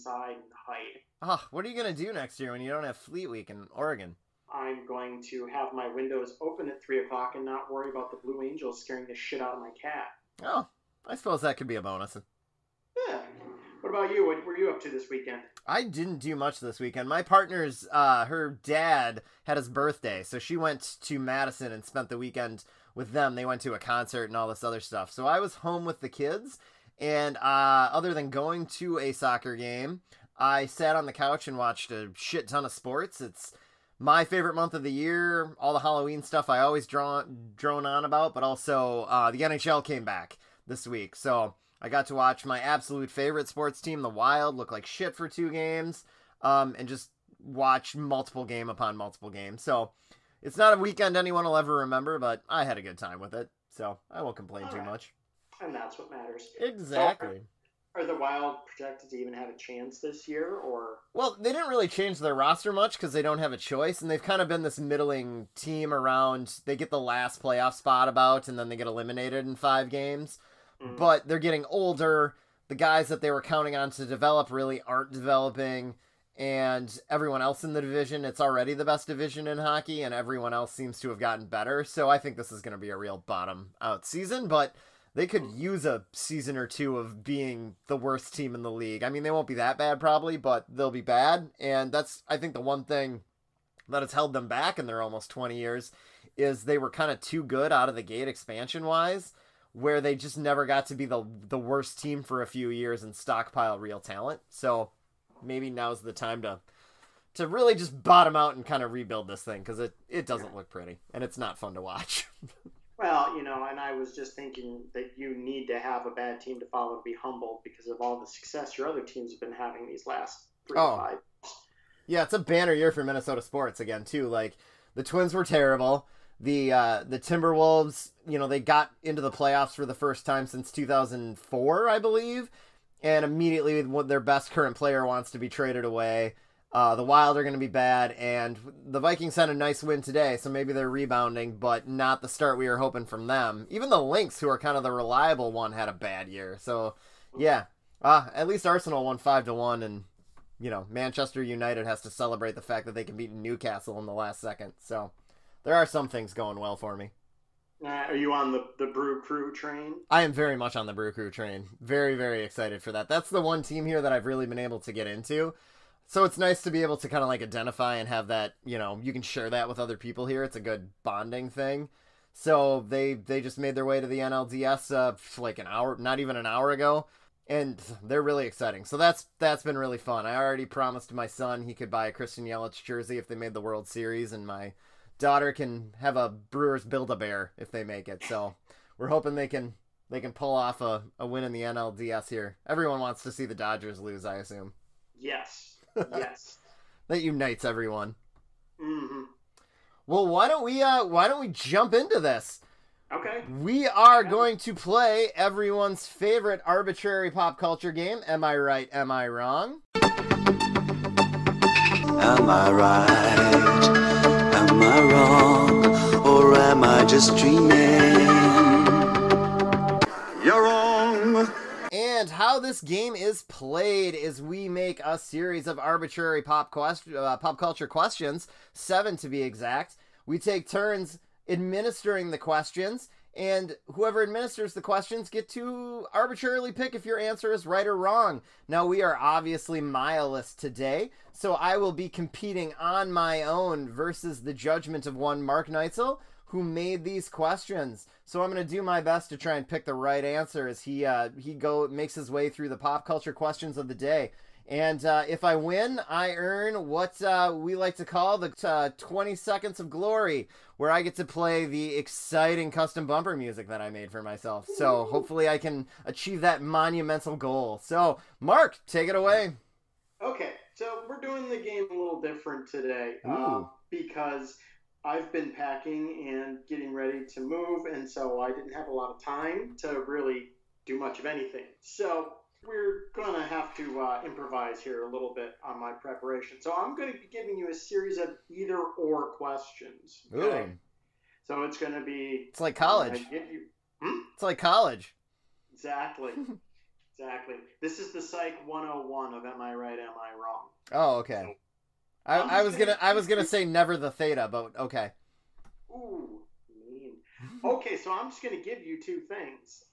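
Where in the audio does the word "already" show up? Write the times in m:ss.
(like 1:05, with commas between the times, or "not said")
1:18, 3:00.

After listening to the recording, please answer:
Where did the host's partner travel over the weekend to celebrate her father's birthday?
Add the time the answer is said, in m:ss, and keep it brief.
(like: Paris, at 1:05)
Madison, at 0:21.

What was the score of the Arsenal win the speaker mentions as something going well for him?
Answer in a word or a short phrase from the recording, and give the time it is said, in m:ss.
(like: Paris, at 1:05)
5 to 1, at 2:29.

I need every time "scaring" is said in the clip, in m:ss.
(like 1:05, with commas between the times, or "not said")
0:08.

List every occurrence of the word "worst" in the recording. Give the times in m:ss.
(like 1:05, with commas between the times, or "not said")
1:27, 1:41.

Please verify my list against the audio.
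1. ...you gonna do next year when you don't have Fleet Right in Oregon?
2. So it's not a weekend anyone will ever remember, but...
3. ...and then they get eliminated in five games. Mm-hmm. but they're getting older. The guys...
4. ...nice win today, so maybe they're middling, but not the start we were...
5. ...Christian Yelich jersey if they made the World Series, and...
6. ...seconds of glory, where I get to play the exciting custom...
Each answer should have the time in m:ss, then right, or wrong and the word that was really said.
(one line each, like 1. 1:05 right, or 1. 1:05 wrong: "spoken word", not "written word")
1. 0:01 wrong: "Week", not "Right"
2. 0:49 right
3. 1:08 right
4. 2:19 wrong: "rebounding", not "middling"
5. 3:02 right
6. 4:19 right.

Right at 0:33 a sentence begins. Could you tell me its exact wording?
It's my favorite month of the year.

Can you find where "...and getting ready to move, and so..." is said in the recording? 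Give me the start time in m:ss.
4:36.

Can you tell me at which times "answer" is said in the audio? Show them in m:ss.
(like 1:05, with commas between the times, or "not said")
3:57, 4:10.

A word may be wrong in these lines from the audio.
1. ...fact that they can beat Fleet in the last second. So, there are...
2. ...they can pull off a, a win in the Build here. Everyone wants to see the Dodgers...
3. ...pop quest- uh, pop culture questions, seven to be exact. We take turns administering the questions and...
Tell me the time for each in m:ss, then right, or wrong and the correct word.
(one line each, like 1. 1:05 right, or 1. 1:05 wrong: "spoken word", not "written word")
1. 2:32 wrong: "Newcastle", not "Fleet"
2. 3:10 wrong: "NLDS", not "Build"
3. 3:46 right.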